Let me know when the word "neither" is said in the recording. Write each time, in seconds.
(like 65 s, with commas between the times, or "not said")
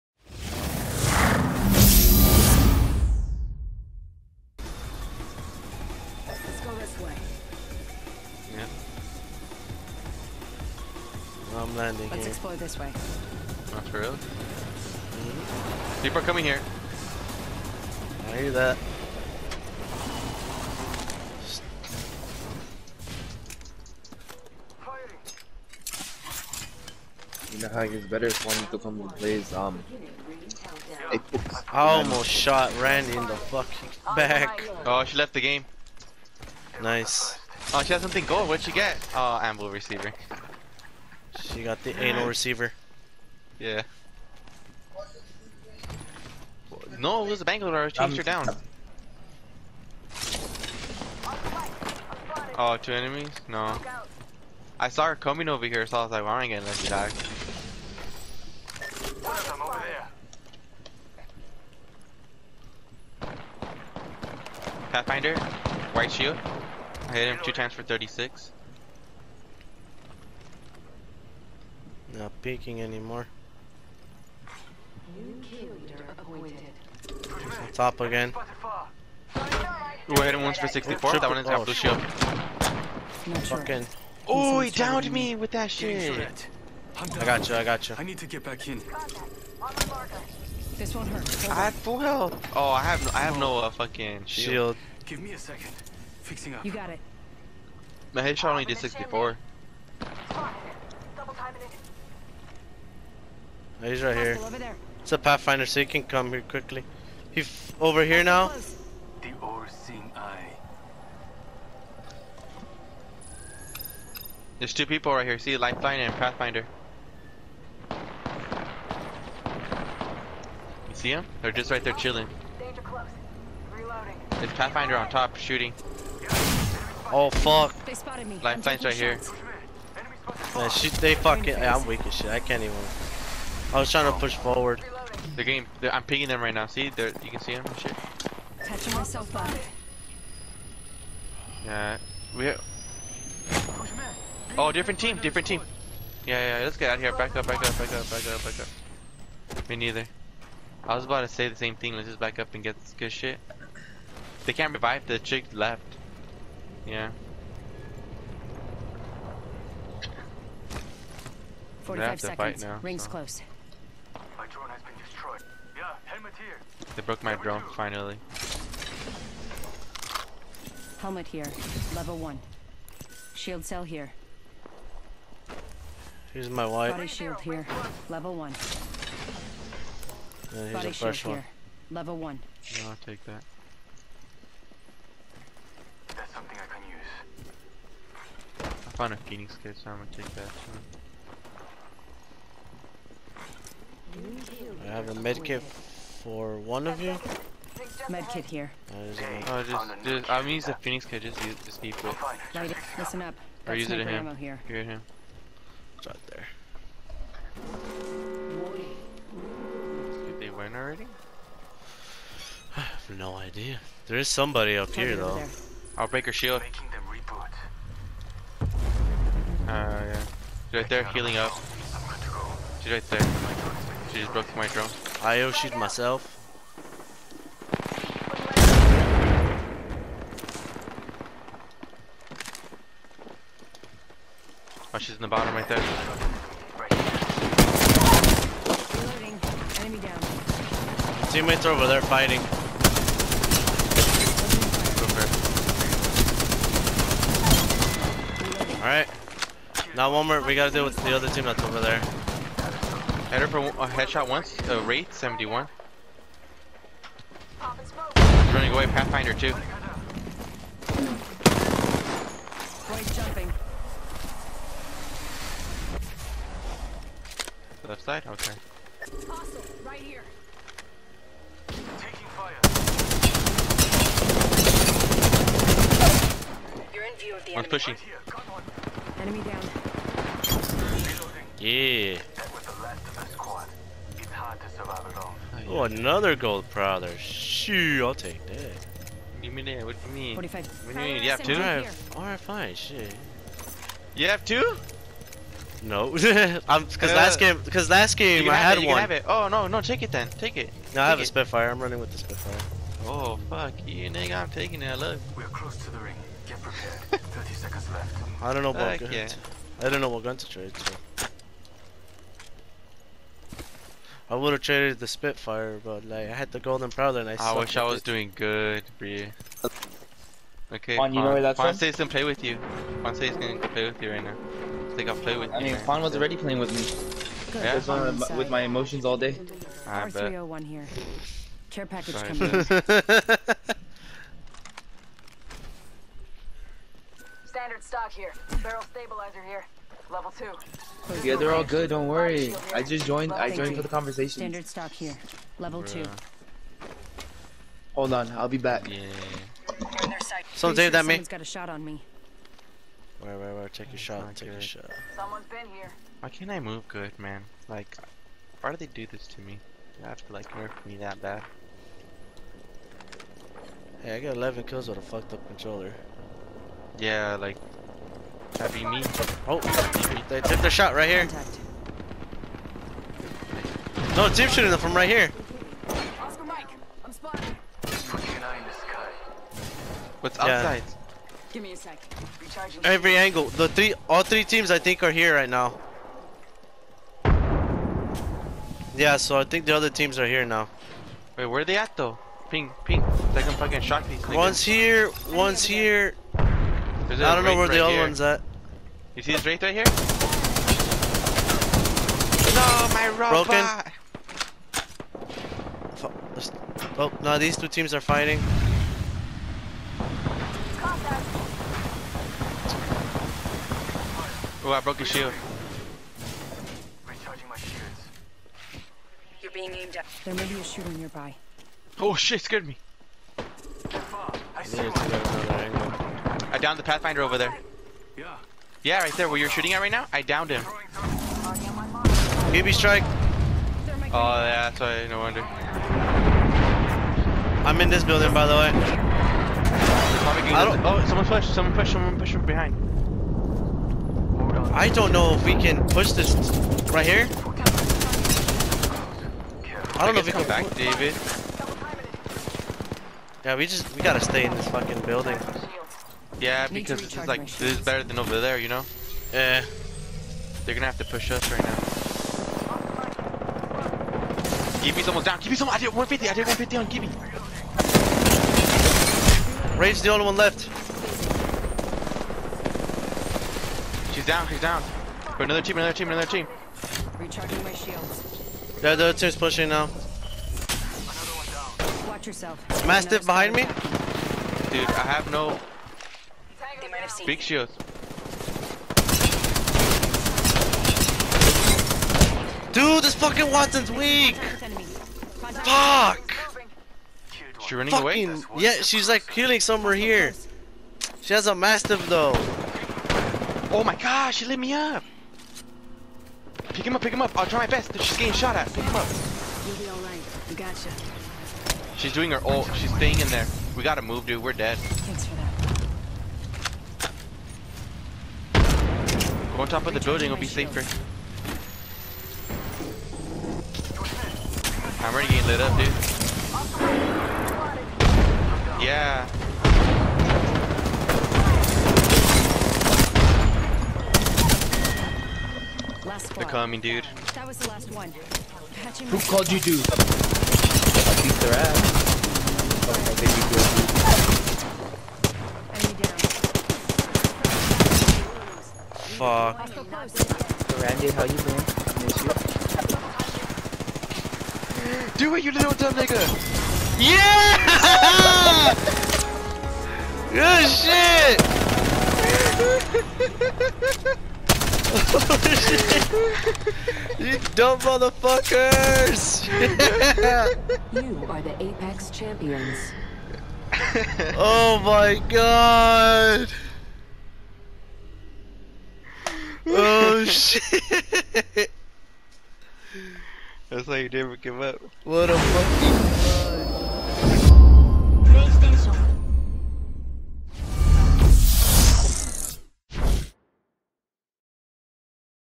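149 s.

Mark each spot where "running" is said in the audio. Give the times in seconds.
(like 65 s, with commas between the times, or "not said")
301 s, 497 s.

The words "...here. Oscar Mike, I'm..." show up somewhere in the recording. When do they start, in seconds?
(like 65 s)
375 s.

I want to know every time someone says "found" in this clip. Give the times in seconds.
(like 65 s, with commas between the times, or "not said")
188 s.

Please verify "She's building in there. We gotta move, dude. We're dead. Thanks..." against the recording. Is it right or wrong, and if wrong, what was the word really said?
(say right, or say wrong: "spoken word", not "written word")
wrong: "staying", not "building".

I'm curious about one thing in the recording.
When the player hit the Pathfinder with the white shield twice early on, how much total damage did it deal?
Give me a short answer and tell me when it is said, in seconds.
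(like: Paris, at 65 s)
36, at 67 s.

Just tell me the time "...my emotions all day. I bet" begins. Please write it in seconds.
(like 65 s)
328 s.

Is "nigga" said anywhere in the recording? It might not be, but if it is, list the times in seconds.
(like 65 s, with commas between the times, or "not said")
304 s, 555 s.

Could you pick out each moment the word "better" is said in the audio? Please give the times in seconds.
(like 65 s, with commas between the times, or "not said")
28 s, 457 s.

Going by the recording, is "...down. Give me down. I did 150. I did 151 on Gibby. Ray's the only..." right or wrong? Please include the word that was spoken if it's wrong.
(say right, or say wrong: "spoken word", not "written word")
wrong: "150", not "151".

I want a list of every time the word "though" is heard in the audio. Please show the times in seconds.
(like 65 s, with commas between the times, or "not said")
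215 s, 391 s, 502 s.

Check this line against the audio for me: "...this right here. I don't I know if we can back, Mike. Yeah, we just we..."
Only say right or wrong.
wrong.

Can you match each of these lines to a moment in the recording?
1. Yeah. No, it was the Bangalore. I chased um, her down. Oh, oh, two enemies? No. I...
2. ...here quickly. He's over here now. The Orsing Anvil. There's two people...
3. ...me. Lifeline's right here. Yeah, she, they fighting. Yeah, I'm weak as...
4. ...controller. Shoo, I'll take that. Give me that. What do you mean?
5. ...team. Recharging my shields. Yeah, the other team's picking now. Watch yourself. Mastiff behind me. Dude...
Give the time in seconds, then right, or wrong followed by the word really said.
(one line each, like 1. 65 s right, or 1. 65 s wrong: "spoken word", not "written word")
1. 43 s right
2. 106 s wrong: "Eye", not "Anvil"
3. 128 s wrong: "fucking", not "fighting"
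4. 286 s wrong: "prowler", not "controller"
5. 476 s wrong: "pushing", not "picking".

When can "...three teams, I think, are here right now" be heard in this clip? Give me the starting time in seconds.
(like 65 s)
384 s.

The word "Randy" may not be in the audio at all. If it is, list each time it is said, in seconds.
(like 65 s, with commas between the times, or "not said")
32 s, 550 s.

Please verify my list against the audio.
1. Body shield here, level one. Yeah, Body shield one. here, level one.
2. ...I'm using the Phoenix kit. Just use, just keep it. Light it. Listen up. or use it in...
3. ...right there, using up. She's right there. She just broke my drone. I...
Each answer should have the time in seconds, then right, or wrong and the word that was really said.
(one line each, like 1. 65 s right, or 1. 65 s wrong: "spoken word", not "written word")
1. 176 s right
2. 200 s right
3. 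220 s wrong: "healing", not "using".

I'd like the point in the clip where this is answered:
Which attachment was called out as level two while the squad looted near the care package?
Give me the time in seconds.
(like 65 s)
338 s.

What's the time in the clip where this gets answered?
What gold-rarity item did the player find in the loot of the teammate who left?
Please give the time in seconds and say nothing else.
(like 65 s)
39 s.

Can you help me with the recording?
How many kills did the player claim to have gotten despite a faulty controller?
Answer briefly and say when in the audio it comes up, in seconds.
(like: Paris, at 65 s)
11, at 364 s.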